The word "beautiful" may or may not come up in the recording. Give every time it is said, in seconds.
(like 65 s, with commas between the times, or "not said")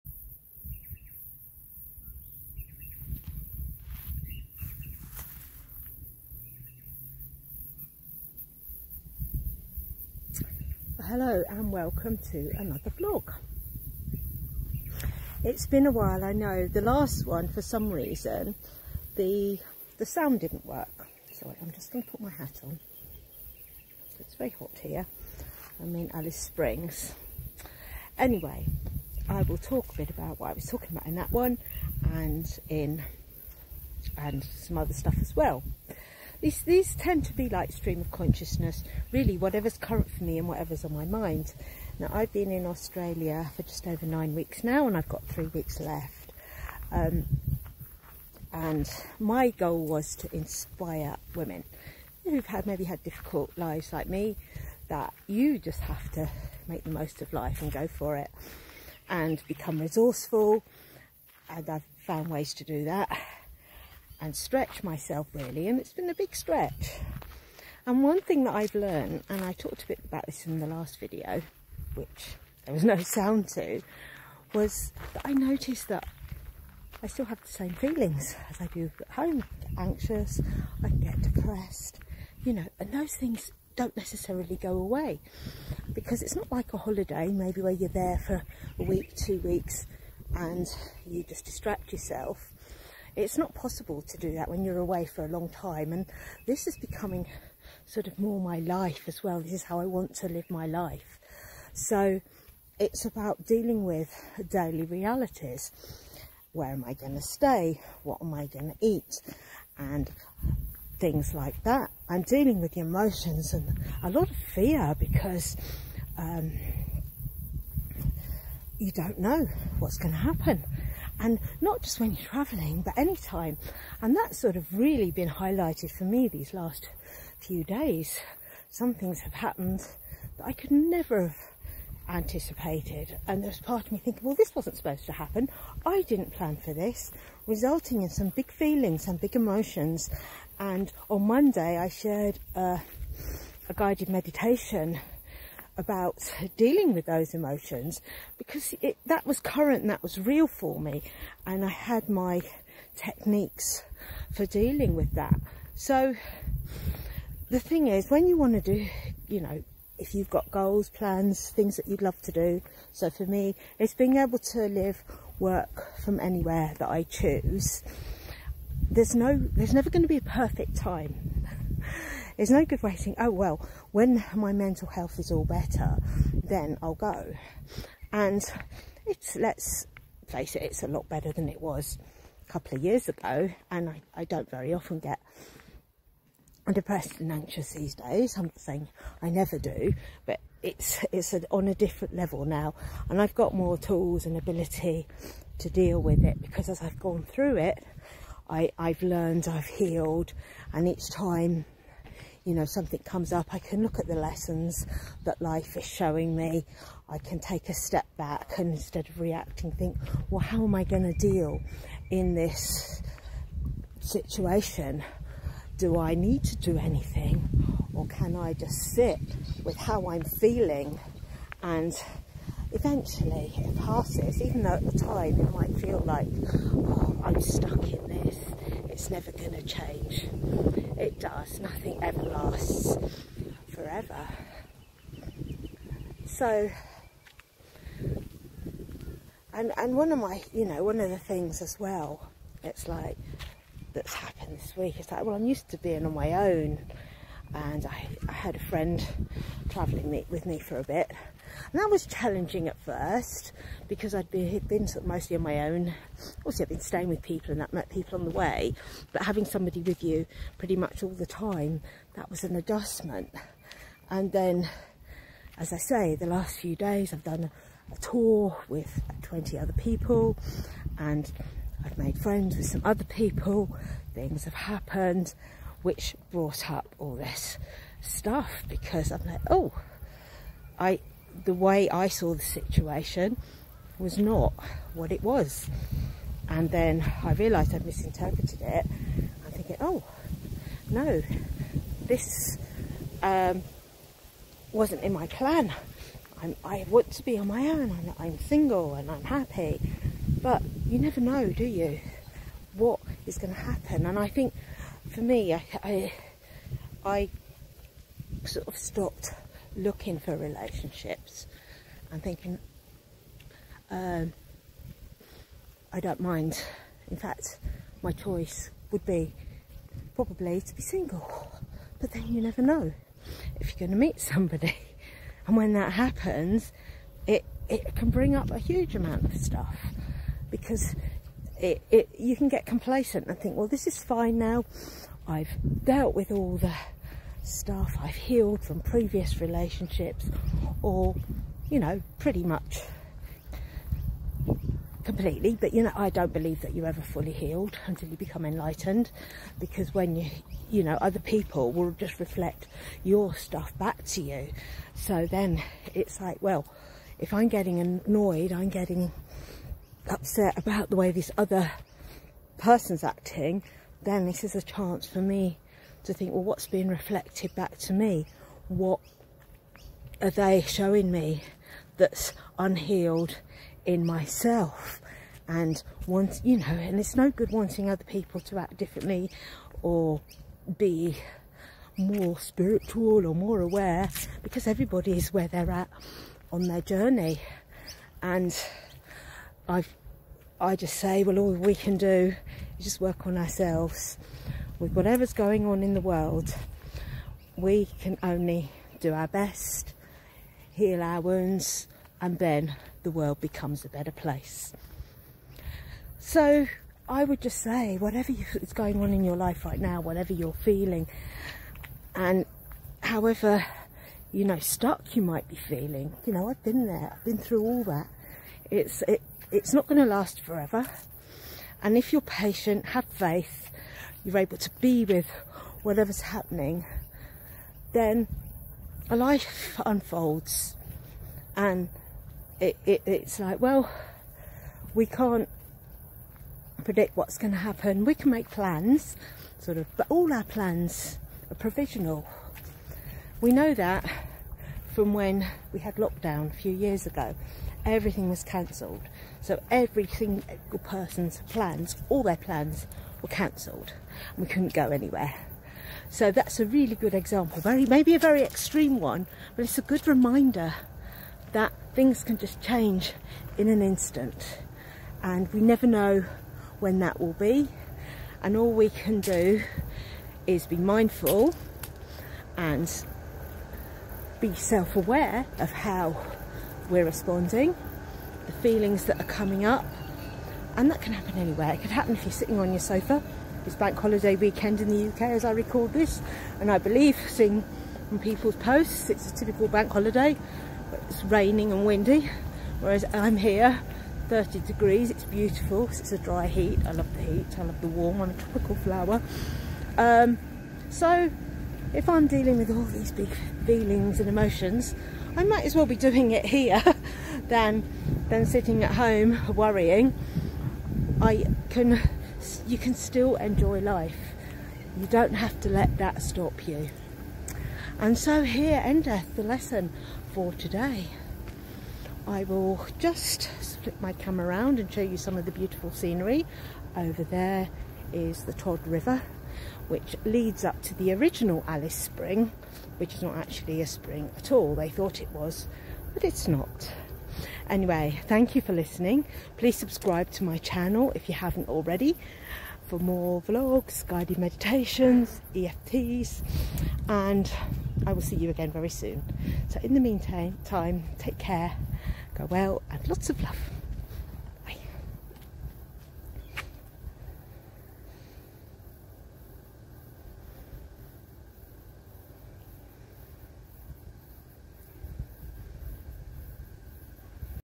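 495 s, 525 s.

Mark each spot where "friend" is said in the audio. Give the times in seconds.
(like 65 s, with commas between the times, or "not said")
248 s, 272 s.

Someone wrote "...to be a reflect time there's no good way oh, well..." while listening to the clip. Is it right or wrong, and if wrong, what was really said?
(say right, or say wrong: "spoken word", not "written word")
wrong: "perfect", not "reflect".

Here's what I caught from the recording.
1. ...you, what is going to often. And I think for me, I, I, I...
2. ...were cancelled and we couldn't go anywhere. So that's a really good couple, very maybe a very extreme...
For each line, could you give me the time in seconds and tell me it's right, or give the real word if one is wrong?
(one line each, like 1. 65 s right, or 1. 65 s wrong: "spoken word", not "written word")
1. 301 s wrong: "happen", not "often"
2. 453 s wrong: "example", not "couple".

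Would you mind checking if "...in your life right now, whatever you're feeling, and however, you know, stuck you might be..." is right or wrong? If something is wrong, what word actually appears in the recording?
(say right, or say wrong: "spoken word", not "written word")
right.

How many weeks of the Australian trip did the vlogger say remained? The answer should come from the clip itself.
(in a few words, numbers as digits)
3.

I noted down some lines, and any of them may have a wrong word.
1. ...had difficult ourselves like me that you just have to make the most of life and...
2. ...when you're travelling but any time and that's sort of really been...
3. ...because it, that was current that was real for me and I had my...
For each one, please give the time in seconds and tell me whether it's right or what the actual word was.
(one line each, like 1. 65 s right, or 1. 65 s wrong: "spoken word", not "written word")
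1. 52 s wrong: "lives", not "ourselves"
2. 121 s right
3. 148 s right.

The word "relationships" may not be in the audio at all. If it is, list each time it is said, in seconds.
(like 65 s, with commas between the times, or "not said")
310 s, 339 s.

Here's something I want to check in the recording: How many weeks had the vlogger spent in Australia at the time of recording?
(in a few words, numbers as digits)
9.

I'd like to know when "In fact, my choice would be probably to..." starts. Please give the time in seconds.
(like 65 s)
317 s.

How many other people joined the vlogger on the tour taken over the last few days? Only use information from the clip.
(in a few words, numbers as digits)
20.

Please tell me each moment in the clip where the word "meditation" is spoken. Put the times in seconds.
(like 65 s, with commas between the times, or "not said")
144 s, 544 s.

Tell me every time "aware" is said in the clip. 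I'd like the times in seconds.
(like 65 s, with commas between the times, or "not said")
383 s, 474 s.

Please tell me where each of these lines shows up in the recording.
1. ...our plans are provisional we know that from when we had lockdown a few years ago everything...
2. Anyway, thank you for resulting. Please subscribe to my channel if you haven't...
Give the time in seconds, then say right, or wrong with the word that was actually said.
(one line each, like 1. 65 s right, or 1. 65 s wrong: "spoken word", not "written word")
1. 440 s right
2. 537 s wrong: "listening", not "resulting".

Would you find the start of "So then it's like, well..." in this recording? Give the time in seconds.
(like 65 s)
354 s.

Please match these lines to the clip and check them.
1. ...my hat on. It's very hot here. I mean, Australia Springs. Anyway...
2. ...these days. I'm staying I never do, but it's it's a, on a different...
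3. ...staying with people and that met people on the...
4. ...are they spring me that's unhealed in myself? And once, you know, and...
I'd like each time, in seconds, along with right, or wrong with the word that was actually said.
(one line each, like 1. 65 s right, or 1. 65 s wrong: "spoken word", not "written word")
1. 22 s wrong: "Alice", not "Australia"
2. 187 s wrong: "saying", not "staying"
3. 256 s right
4. 370 s wrong: "showing", not "spring".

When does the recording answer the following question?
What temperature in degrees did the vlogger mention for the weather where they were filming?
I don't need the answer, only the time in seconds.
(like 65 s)
494 s.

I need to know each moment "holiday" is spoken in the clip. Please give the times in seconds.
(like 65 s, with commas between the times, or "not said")
86 s, 483 s, 489 s.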